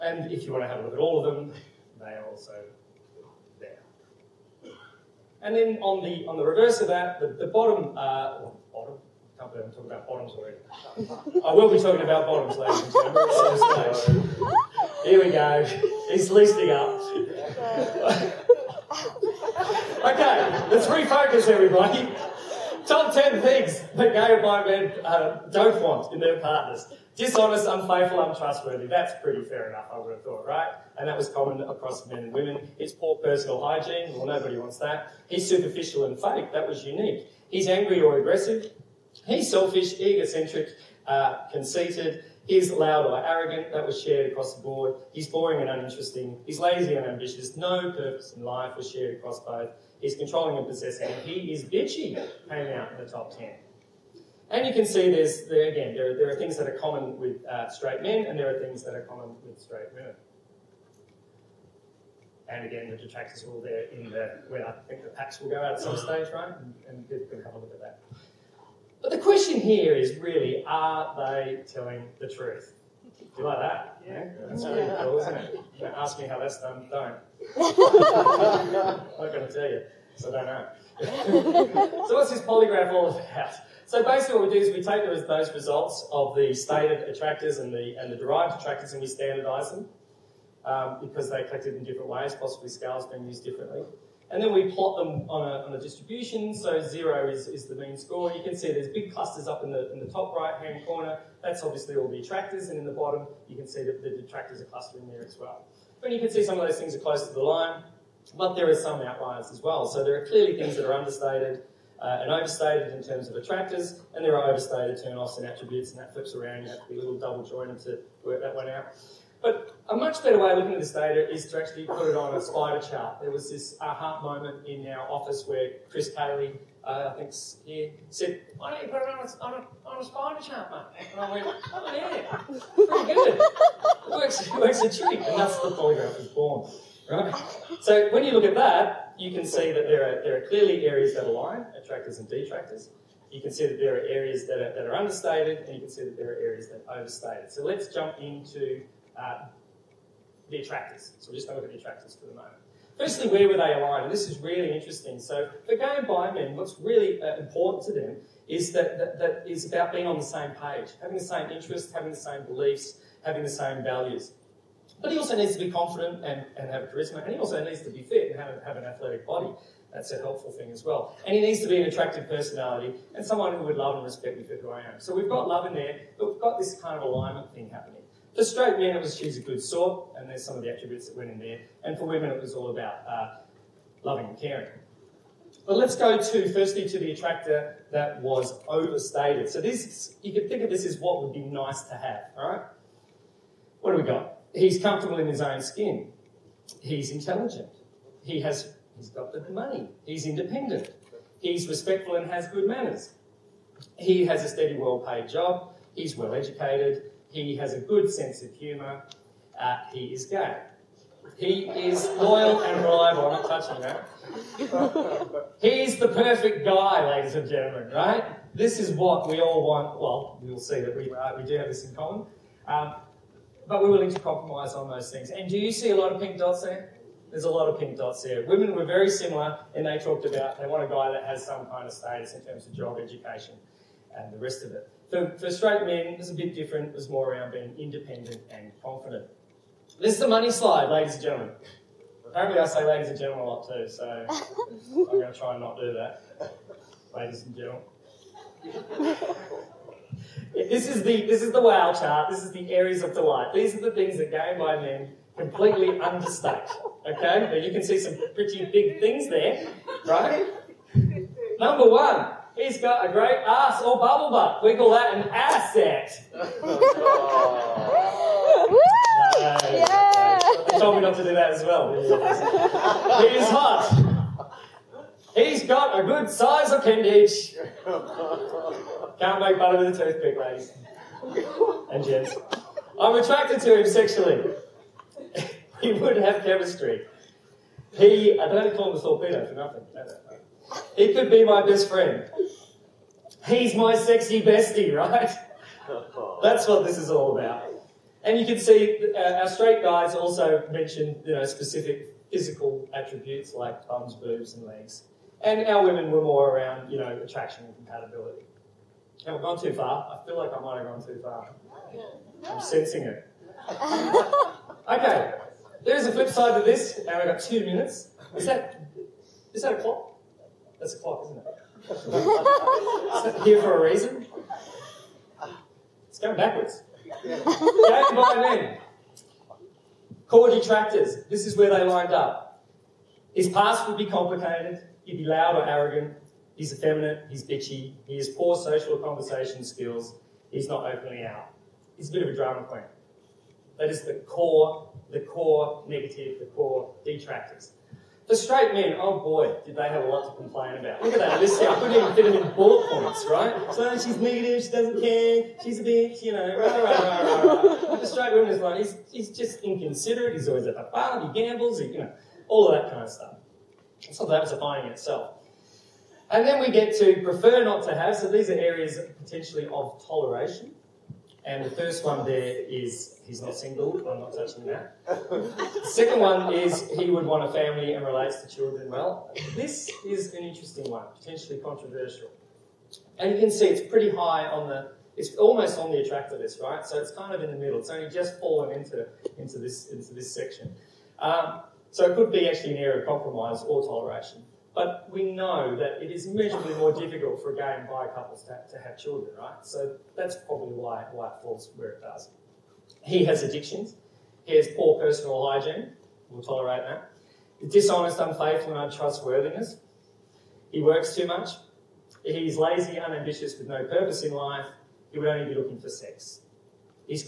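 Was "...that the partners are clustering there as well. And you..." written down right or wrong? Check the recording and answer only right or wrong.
wrong.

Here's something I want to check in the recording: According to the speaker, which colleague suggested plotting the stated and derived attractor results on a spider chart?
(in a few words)
Chris Cayley.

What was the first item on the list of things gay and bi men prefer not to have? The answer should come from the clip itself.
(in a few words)
he's not single.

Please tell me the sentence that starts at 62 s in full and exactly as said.
And again, the detractors are all there in the, where I think the packs will go out at some mm.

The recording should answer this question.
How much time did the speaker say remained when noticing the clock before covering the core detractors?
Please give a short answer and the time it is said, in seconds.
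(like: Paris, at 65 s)
2 minutes, at 317 s.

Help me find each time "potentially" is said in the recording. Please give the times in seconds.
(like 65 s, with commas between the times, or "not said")
369 s, 381 s.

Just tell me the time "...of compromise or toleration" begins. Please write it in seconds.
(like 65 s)
393 s.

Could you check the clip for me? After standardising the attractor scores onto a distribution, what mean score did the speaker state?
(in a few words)
0.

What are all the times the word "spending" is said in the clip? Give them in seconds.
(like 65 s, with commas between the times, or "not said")
not said.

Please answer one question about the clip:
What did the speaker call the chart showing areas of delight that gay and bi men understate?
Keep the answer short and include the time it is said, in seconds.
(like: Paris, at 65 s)
the wow chart, at 251 s.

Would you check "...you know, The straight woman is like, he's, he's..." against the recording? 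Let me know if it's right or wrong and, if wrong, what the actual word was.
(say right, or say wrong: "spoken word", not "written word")
right.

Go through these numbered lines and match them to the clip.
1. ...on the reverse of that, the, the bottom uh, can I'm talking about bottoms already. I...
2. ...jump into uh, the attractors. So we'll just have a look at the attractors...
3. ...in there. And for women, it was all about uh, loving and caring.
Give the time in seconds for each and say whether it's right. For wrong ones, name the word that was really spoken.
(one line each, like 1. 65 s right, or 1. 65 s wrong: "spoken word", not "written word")
1. 6 s right
2. 147 s right
3. 181 s right.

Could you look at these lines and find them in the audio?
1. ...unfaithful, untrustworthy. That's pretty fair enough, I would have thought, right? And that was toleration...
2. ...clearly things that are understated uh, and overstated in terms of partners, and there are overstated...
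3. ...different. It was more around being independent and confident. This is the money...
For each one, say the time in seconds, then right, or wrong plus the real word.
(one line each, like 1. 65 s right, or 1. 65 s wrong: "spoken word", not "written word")
1. 27 s wrong: "common", not "toleration"
2. 110 s wrong: "attractors", not "partners"
3. 236 s right.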